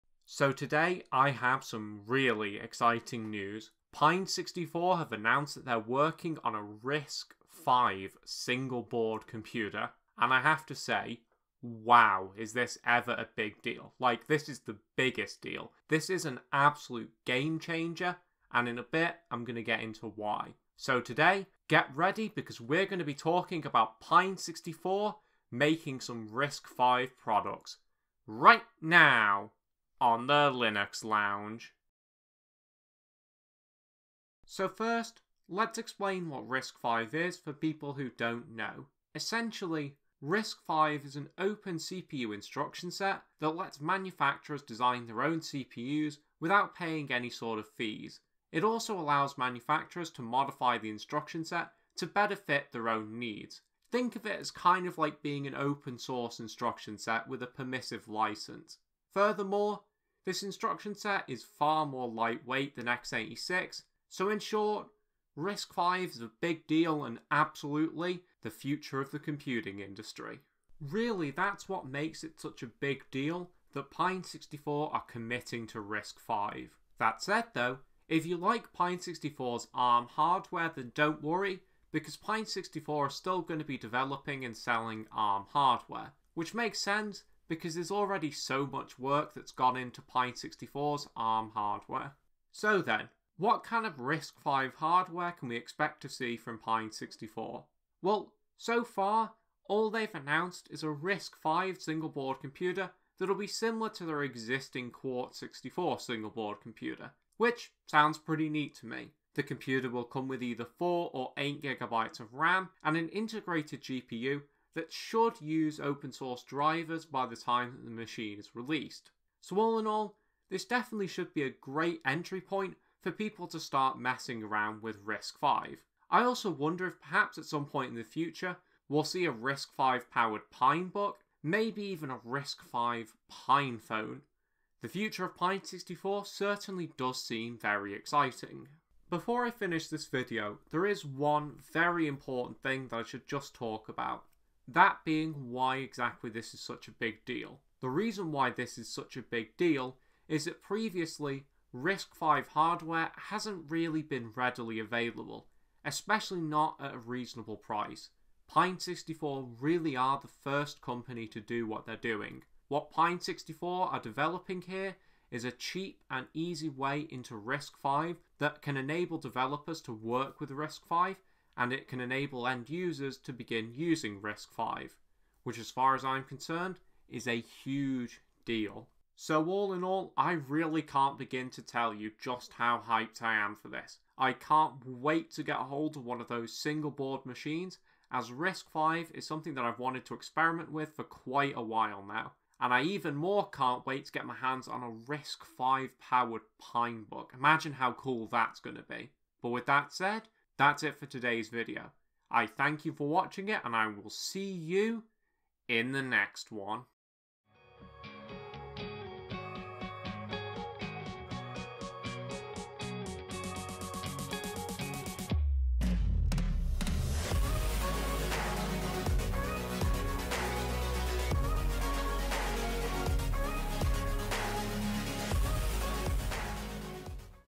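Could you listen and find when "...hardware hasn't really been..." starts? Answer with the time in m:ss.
2:32.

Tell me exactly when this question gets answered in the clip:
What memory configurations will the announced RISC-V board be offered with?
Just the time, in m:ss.
1:50.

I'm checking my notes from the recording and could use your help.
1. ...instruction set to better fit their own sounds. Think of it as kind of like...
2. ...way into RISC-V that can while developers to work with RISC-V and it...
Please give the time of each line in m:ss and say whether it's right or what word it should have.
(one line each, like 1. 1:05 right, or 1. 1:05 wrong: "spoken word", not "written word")
1. 0:50 wrong: "needs", not "sounds"
2. 2:46 wrong: "enable", not "while".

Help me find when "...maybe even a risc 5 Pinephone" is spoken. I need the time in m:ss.
2:11.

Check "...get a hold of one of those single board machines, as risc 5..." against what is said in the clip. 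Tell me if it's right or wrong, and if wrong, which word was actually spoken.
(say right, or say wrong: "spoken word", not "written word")
right.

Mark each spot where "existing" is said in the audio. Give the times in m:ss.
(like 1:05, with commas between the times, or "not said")
1:44.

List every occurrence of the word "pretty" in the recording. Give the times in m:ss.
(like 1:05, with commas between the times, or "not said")
1:48.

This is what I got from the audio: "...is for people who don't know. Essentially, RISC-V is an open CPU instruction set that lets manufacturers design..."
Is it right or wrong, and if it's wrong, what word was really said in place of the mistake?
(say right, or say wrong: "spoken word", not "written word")
right.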